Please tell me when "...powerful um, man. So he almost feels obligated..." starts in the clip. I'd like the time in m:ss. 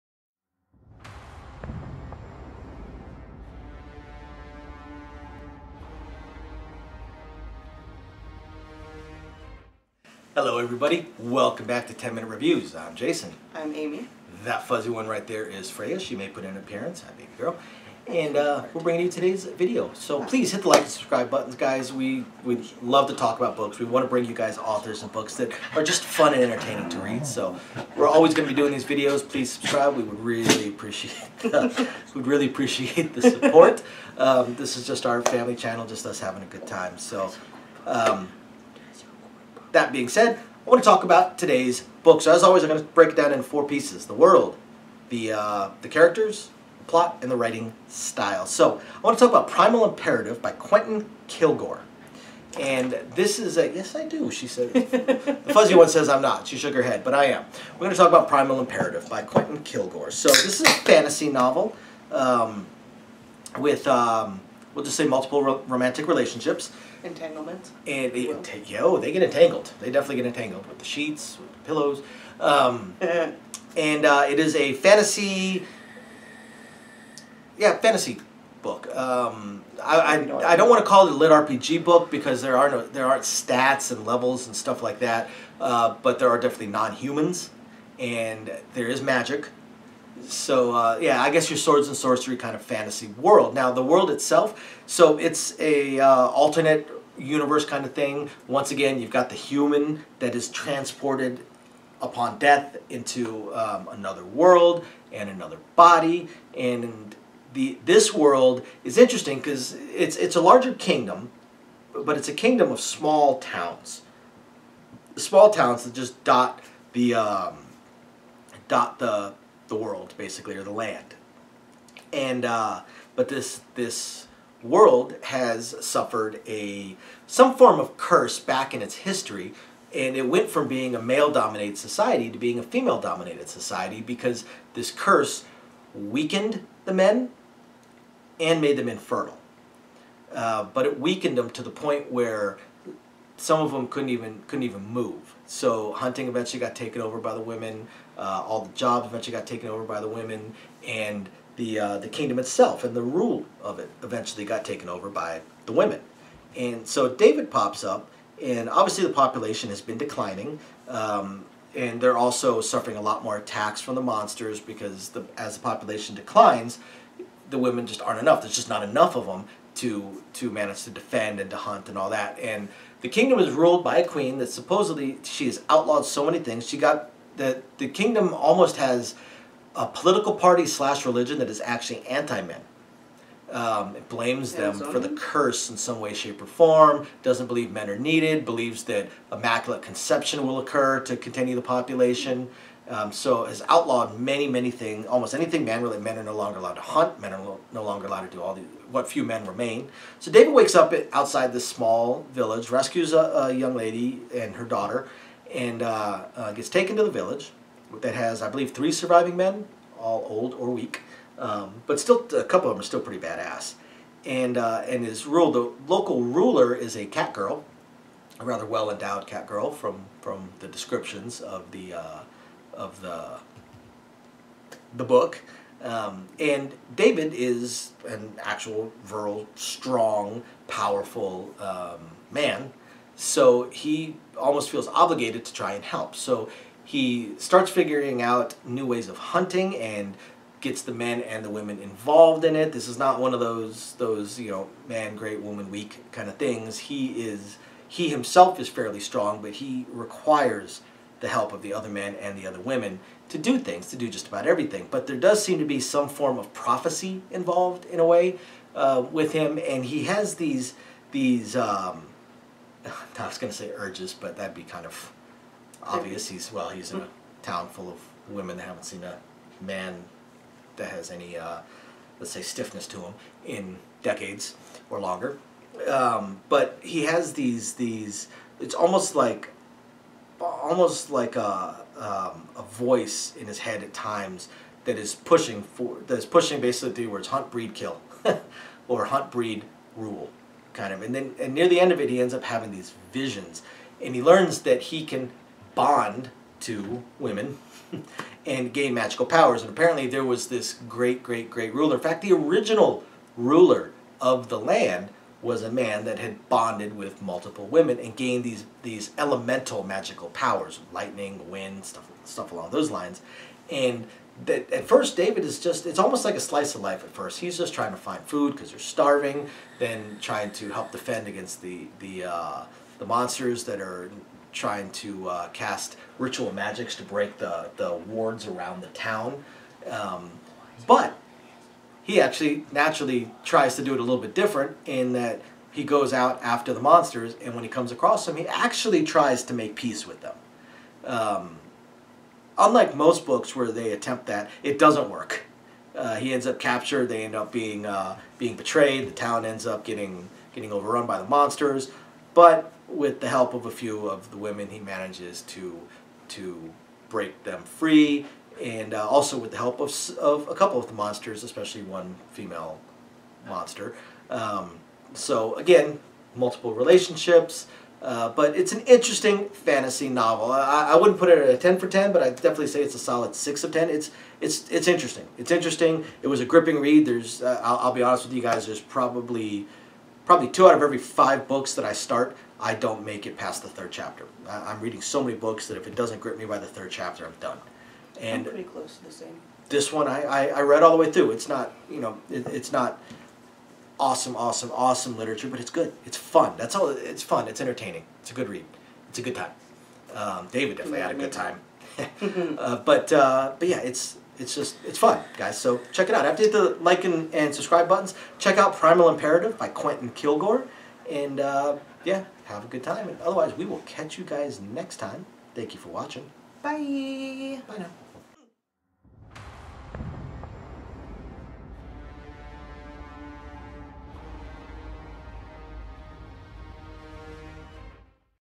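3:50.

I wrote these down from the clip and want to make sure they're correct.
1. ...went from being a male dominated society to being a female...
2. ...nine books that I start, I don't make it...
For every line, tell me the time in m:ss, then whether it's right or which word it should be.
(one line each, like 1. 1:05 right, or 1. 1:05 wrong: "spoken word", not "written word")
1. 2:10 right
2. 6:20 wrong: "five", not "nine".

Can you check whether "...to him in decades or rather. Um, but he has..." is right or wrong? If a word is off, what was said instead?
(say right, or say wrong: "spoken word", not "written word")
wrong: "longer", not "rather".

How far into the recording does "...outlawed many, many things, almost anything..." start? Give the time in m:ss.
3:13.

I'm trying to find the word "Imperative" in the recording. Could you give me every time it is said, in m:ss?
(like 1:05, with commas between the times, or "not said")
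0:49, 0:58, 6:49.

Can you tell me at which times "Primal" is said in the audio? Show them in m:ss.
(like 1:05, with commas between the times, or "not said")
0:49, 0:58, 6:48.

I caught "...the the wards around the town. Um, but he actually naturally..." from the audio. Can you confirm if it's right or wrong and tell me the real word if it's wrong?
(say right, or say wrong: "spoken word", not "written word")
right.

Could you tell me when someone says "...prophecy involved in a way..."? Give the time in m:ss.
4:16.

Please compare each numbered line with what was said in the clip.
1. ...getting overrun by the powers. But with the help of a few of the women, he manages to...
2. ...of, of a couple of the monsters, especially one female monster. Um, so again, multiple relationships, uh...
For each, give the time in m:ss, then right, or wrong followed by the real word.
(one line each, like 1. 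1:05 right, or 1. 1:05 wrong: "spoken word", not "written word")
1. 5:50 wrong: "monsters", not "powers"
2. 5:59 right.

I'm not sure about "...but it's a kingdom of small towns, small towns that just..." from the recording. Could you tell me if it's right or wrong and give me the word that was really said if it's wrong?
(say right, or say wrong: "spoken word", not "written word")
right.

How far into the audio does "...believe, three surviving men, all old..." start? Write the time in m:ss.
3:28.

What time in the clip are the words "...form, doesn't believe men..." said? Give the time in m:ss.
3:06.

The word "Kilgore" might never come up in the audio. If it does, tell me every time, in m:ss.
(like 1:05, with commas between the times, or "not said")
0:51, 0:59, 6:50.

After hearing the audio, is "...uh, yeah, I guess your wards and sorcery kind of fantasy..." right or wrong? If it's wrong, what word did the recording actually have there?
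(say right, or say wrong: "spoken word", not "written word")
wrong: "swords", not "wards".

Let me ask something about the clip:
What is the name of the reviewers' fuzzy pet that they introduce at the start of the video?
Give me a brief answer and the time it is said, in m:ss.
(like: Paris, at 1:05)
Freya, at 0:15.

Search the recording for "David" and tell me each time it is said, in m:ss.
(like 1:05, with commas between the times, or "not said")
2:37, 3:20, 3:46, 5:15, 6:40.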